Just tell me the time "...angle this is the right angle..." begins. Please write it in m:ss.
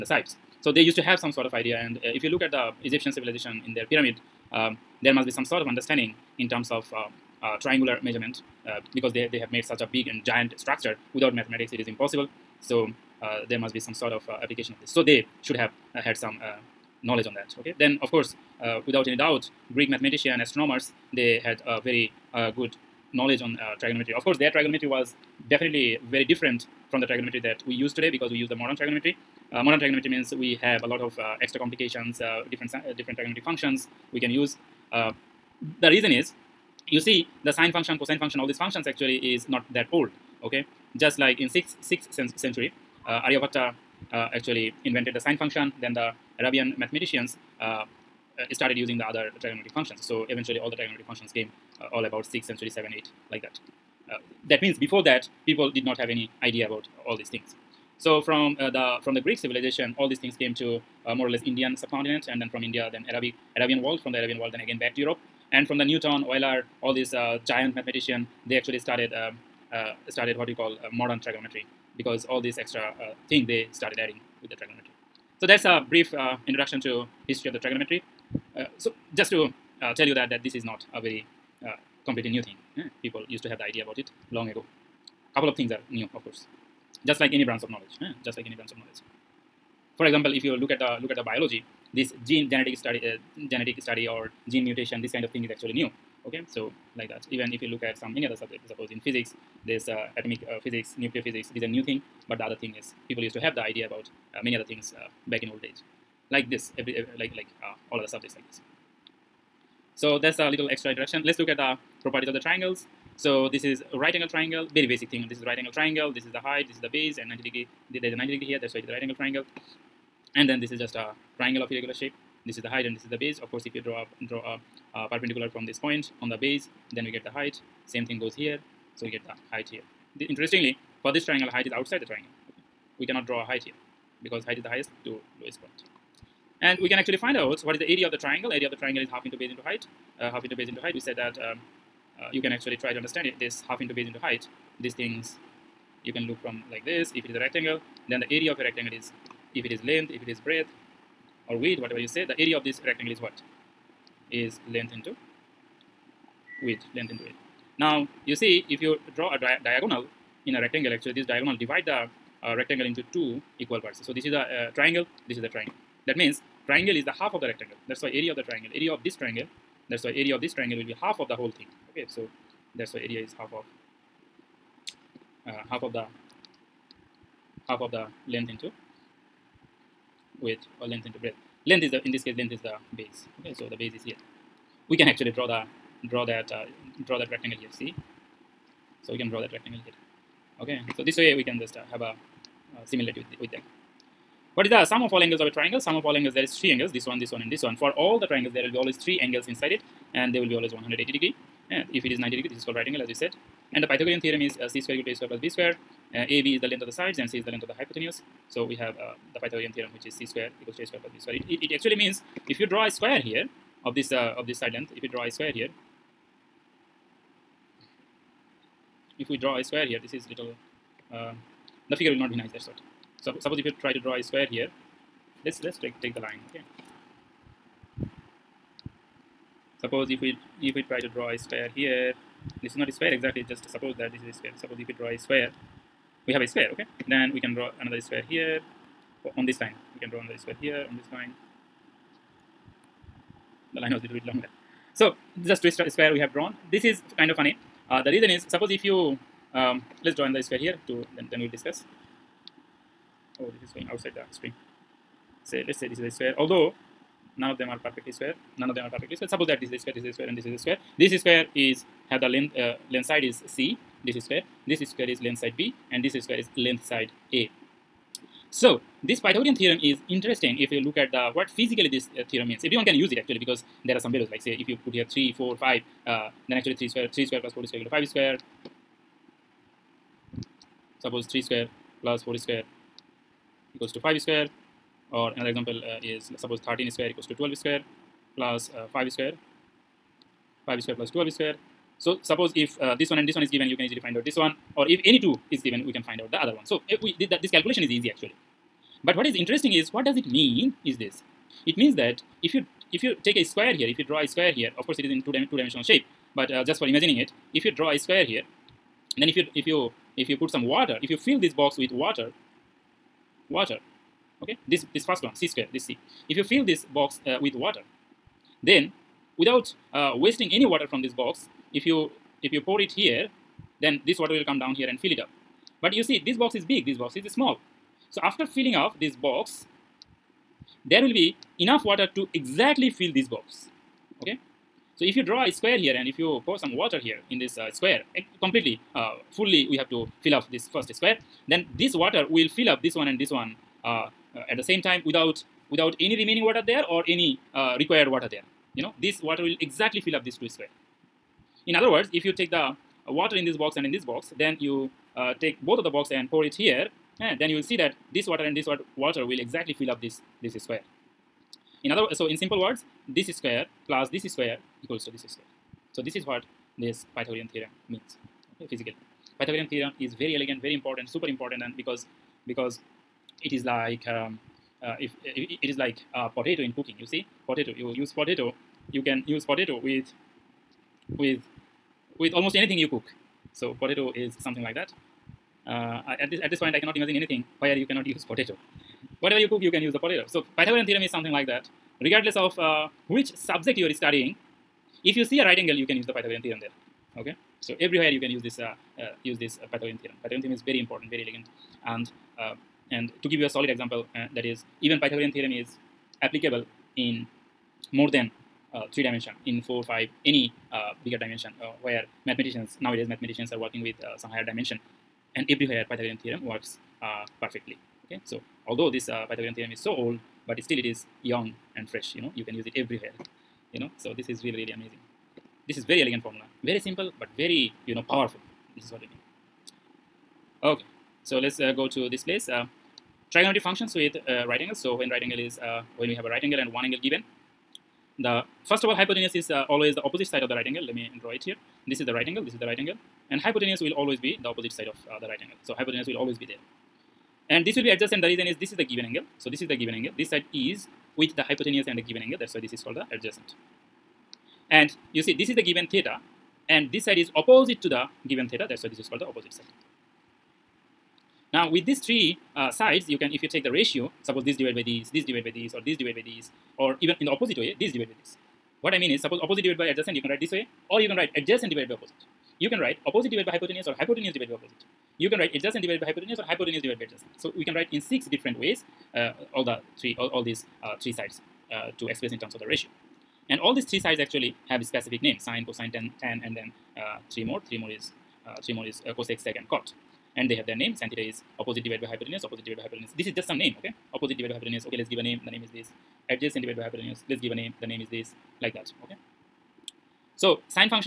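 7:22.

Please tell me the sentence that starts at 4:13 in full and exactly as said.
Oh, this is going outside the string.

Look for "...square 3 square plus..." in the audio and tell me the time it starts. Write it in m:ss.
4:36.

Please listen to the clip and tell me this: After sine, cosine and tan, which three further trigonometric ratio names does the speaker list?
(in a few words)
cosec, sec and cot.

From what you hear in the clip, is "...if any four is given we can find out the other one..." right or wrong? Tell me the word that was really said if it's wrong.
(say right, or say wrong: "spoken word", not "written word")
wrong: "two", not "four".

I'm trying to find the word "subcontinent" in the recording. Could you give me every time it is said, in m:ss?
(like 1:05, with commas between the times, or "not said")
1:01.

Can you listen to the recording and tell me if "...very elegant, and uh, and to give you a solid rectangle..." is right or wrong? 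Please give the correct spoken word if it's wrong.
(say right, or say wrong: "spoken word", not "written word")
wrong: "example", not "rectangle".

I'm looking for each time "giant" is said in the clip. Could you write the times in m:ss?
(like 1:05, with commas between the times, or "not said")
0:10, 1:07.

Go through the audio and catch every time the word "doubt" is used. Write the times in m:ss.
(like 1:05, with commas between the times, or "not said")
0:19.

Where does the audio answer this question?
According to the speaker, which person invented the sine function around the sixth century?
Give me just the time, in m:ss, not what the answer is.
0:43.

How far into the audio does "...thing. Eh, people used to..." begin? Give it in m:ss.
1:22.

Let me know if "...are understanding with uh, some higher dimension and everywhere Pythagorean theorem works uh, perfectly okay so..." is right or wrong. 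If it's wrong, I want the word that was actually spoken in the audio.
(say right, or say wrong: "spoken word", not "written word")
wrong: "working", not "understanding".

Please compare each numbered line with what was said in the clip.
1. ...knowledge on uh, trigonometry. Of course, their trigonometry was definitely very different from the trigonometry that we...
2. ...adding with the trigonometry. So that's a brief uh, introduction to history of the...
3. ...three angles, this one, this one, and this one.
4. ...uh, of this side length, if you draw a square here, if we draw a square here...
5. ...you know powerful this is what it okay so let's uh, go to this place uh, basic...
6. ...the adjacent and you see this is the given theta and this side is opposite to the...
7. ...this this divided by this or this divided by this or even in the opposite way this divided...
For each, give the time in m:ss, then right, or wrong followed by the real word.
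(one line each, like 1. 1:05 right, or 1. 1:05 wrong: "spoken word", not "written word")
1. 0:23 right
2. 1:13 right
3. 3:16 right
4. 3:34 right
5. 7:07 wrong: "trigonometric", not "basic"
6. 7:32 right
7. 7:44 right.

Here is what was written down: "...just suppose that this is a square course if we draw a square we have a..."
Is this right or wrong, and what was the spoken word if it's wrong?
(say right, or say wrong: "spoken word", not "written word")
wrong: "suppose", not "course".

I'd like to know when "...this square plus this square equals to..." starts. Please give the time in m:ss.
6:03.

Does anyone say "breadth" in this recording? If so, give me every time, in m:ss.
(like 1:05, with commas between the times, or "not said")
2:30, 3:01.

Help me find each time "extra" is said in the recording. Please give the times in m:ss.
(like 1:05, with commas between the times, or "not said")
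0:31, 1:12, 1:50.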